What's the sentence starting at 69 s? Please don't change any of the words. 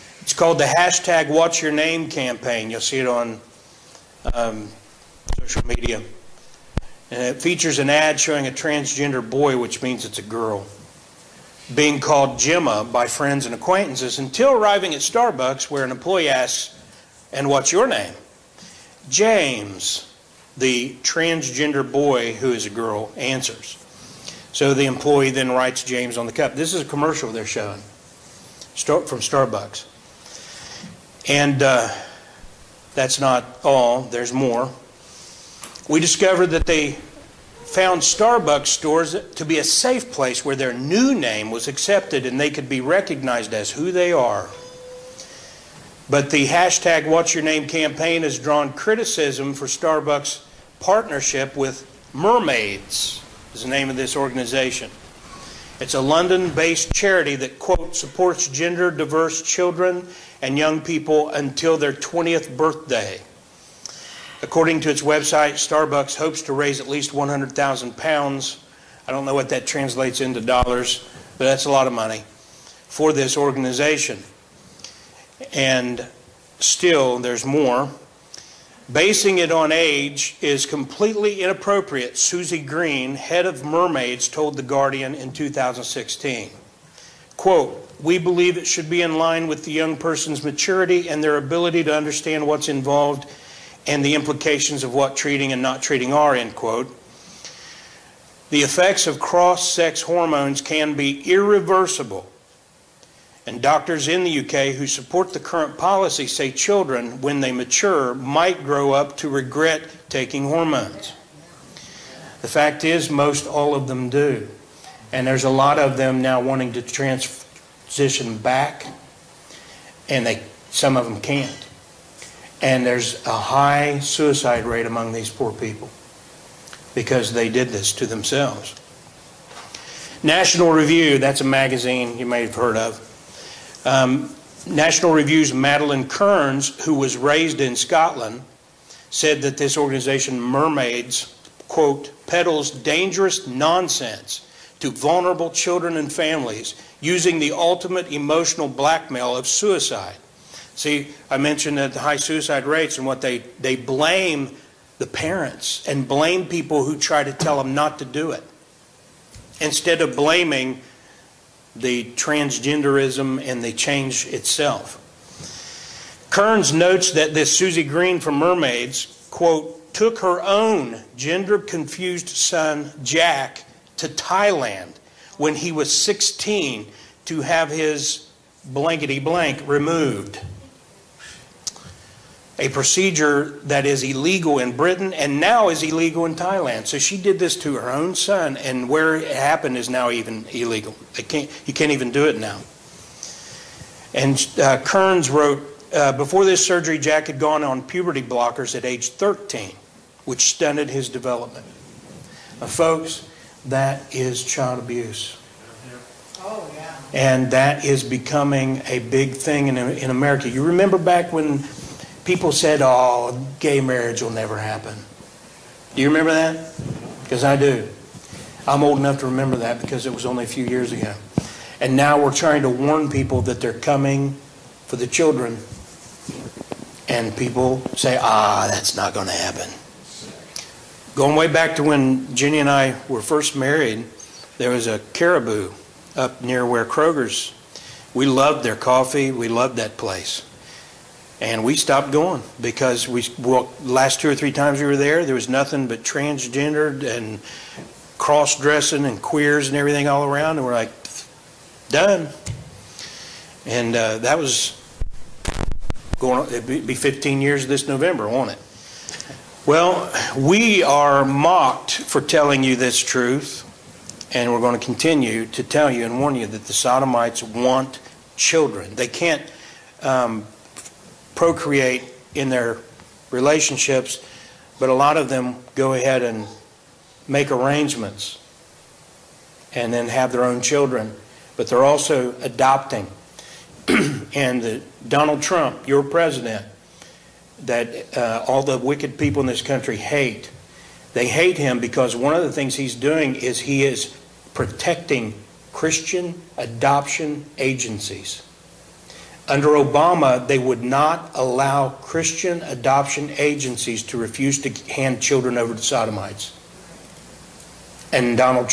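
I don't know what that translates into dollars, but that's a lot of money for this organization.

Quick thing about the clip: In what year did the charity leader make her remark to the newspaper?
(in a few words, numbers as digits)
2016.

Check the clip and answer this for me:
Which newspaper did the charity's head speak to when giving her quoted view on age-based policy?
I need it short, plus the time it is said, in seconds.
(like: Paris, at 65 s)
The Guardian, at 84 s.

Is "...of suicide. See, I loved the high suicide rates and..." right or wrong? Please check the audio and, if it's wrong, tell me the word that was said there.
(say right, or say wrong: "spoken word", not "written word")
wrong: "mentioned", not "loved".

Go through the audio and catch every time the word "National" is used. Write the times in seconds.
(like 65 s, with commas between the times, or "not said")
130 s, 134 s.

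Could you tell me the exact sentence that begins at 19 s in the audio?
James, the transgender boy who is a girl, answers.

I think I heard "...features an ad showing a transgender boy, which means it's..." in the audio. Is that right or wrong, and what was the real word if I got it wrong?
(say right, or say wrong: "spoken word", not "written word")
right.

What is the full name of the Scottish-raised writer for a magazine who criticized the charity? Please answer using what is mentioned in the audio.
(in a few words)
Madeleine Kearns.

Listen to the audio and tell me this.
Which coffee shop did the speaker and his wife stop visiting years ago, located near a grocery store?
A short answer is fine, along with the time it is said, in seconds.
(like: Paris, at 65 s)
Caribou, at 235 s.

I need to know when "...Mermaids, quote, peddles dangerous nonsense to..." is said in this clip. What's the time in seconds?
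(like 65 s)
140 s.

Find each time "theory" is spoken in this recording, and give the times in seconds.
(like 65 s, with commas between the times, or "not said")
not said.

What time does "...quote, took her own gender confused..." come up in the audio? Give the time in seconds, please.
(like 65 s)
169 s.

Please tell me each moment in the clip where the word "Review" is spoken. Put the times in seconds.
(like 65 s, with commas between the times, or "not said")
130 s, 135 s.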